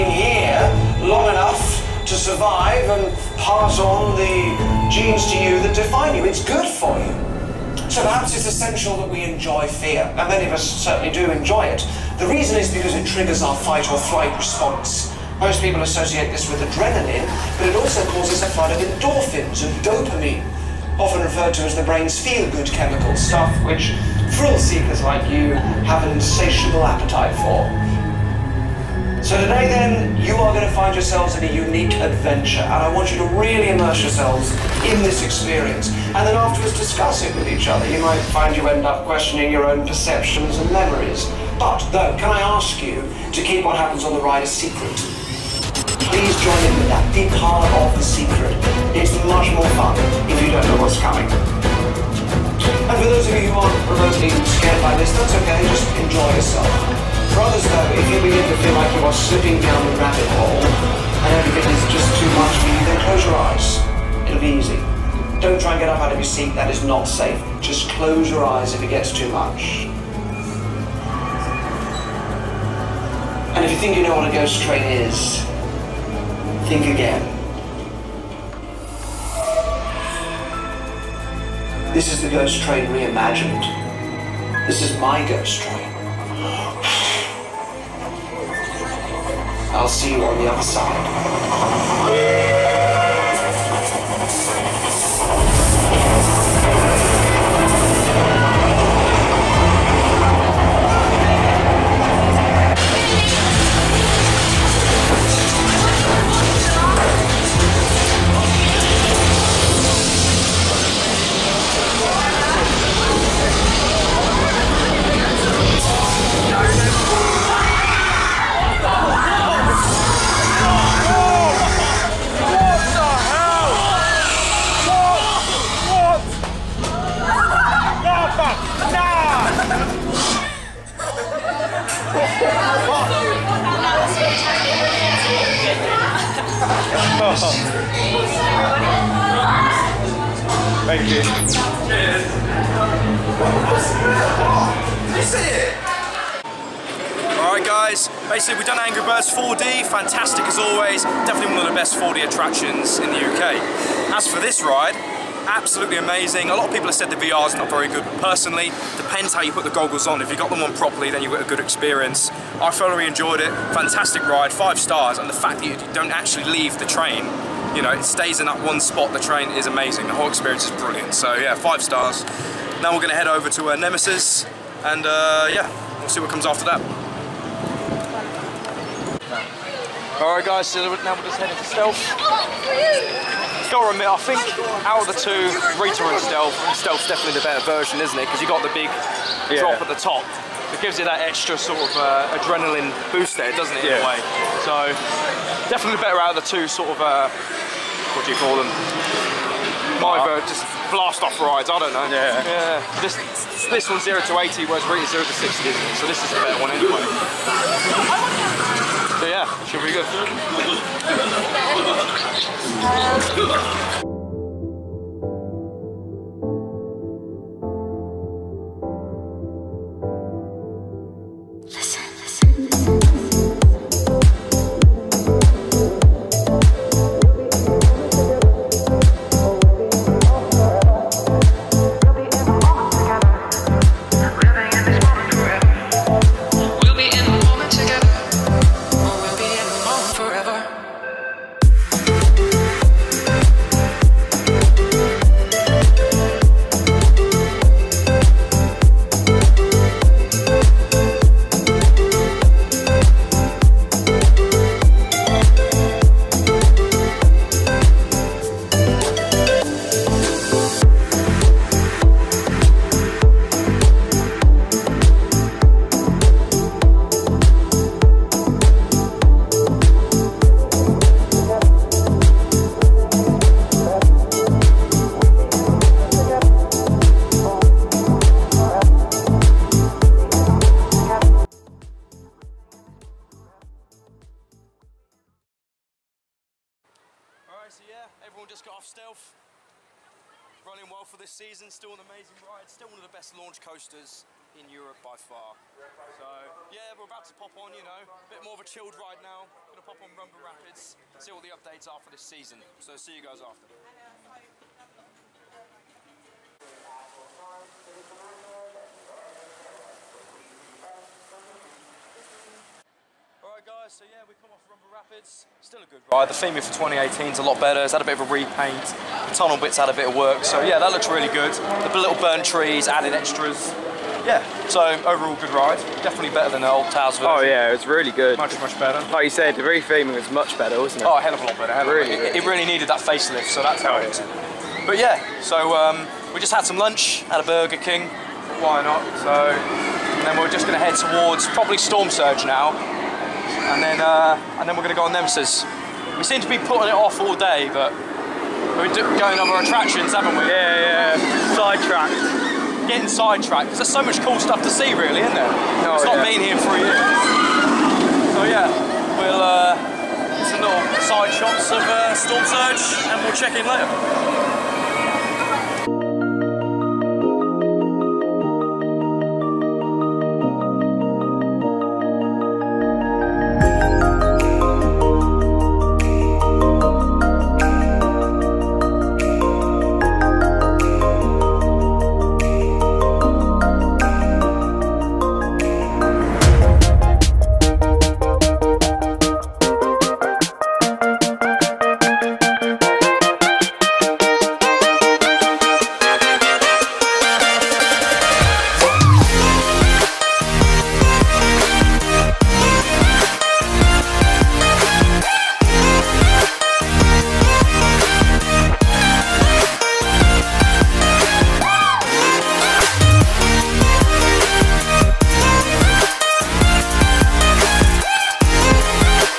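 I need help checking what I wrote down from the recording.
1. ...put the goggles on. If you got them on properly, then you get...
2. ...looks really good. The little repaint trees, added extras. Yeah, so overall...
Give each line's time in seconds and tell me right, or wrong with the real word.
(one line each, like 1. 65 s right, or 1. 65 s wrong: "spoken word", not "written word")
1. 159 s right
2. 320 s wrong: "burnt", not "repaint".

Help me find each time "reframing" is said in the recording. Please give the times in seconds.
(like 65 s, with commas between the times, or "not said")
329 s.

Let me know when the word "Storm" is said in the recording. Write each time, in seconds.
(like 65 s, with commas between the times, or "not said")
341 s, 362 s.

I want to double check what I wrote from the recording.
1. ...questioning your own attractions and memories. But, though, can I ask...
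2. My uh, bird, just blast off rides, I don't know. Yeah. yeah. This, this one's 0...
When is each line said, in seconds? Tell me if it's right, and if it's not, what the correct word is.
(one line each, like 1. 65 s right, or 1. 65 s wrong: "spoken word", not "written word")
1. 39 s wrong: "perceptions", not "attractions"
2. 199 s right.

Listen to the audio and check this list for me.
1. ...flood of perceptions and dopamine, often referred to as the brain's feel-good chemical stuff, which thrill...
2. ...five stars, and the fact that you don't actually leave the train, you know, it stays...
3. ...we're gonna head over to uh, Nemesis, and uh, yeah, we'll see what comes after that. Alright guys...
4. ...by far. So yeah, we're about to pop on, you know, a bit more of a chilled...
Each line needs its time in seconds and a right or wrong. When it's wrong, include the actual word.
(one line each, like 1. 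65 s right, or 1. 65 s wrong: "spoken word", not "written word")
1. 18 s wrong: "endorphins", not "perceptions"
2. 164 s right
3. 172 s right
4. 295 s right.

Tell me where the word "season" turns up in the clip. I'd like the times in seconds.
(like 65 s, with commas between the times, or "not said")
291 s, 302 s.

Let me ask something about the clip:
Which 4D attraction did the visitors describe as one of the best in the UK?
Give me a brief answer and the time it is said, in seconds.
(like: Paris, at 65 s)
Angry Birds 4D, at 148 s.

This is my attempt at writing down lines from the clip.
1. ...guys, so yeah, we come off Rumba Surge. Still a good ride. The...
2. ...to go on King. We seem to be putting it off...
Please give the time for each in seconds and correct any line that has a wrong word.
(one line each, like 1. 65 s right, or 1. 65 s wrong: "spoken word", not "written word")
1. 313 s wrong: "Rapids", not "Surge"
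2. 344 s wrong: "Nemesis", not "King".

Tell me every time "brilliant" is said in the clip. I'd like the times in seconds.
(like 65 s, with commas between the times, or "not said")
170 s.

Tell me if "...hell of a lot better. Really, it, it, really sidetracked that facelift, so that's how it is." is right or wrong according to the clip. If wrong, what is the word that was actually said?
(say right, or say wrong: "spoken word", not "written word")
wrong: "needed", not "sidetracked".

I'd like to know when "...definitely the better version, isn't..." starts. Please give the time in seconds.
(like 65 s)
187 s.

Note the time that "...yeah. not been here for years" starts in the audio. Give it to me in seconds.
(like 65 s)
356 s.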